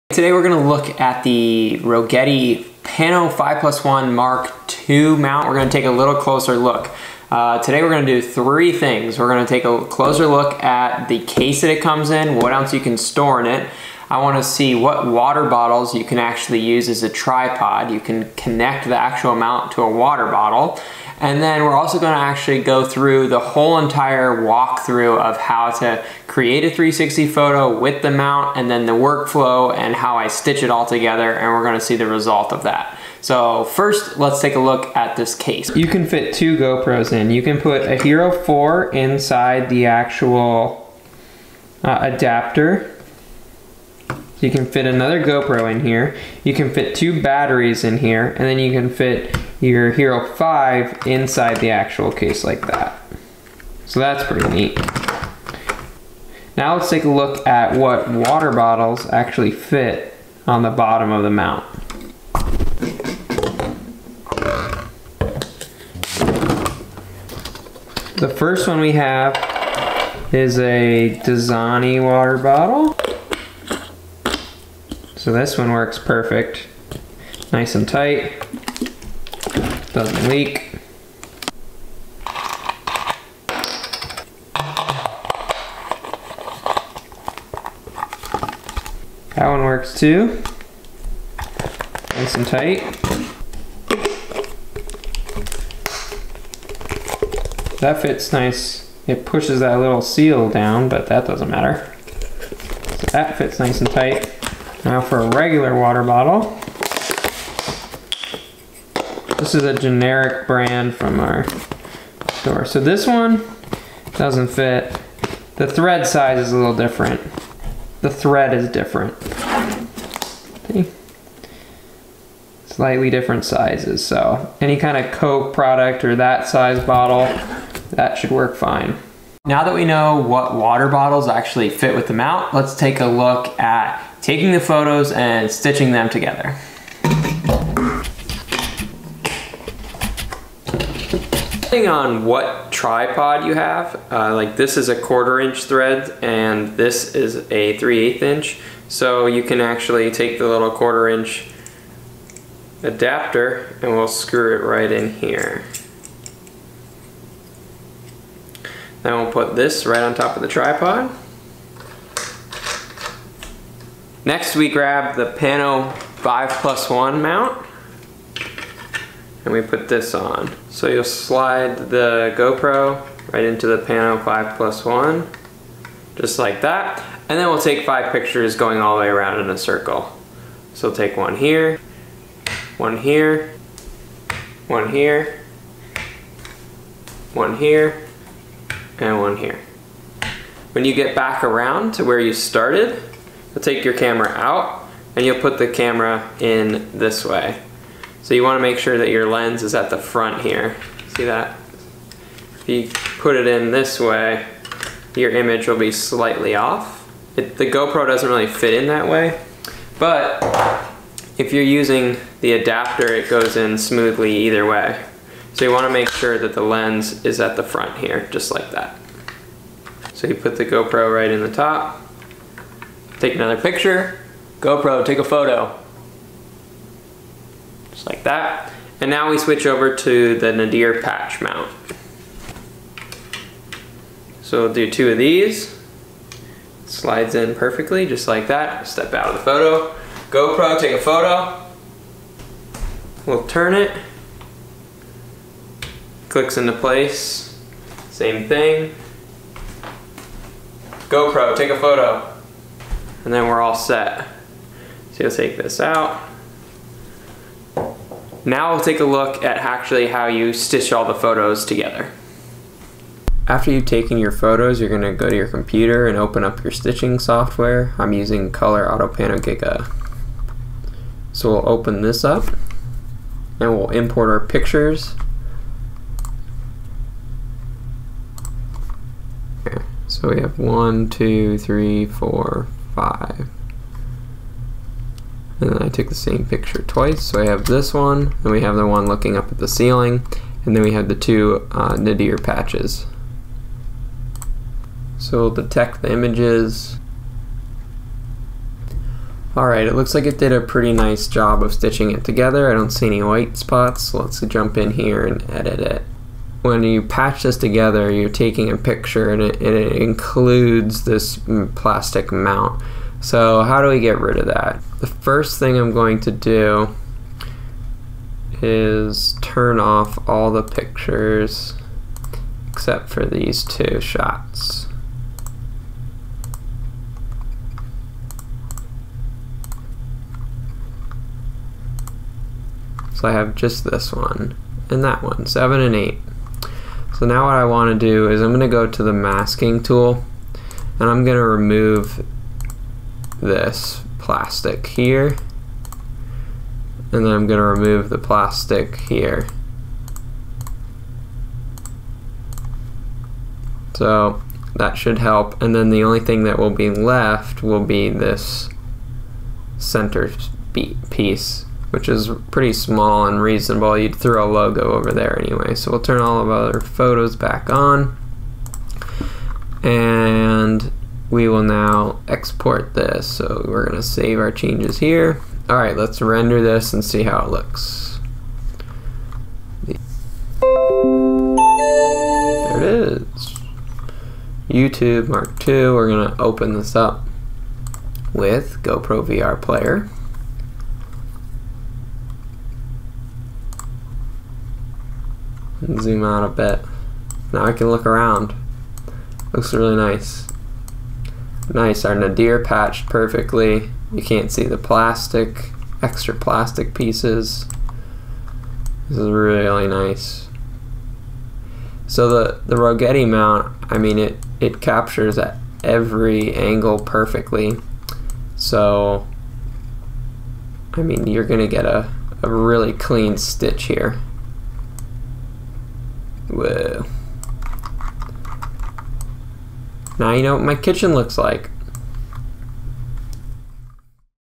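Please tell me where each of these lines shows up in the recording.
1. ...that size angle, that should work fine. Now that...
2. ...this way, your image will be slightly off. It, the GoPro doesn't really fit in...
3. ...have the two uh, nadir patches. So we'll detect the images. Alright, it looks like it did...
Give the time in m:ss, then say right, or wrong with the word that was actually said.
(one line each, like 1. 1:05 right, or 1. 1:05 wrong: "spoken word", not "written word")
1. 2:06 wrong: "bottle", not "angle"
2. 3:23 right
3. 4:50 right.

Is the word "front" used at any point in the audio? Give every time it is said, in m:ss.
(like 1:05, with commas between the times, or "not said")
3:19, 3:37.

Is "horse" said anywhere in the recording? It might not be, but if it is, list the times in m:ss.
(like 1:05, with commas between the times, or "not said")
not said.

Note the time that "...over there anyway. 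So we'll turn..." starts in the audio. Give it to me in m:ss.
6:04.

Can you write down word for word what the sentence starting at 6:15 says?
All right, let's render this and see how it looks.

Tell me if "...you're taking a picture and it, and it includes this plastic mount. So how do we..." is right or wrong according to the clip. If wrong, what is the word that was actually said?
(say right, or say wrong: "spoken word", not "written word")
right.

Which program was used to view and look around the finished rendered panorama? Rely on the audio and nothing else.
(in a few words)
GoPro VR Player.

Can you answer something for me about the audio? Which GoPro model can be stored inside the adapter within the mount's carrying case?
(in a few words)
Hero 4.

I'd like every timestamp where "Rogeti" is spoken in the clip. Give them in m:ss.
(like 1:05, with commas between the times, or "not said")
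0:01, 6:52.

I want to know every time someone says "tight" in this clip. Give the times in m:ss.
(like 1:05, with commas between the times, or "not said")
1:17, 1:32, 1:43.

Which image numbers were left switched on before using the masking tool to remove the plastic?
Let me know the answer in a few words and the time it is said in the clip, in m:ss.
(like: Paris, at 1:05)
7 and 8, at 5:35.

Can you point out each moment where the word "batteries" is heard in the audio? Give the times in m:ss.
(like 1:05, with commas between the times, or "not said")
0:47.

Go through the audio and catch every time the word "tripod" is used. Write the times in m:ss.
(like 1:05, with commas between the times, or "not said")
0:17, 2:22, 2:40.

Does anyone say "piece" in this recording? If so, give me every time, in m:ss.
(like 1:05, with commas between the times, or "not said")
6:01, 6:46.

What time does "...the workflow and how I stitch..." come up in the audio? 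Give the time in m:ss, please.
0:28.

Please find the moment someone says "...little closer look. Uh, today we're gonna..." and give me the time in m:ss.
0:05.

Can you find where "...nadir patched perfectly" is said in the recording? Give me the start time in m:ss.
6:42.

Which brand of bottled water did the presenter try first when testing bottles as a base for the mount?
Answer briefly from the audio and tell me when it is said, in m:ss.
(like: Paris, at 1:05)
Dasani, at 1:11.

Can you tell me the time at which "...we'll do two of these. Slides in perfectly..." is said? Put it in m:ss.
3:54.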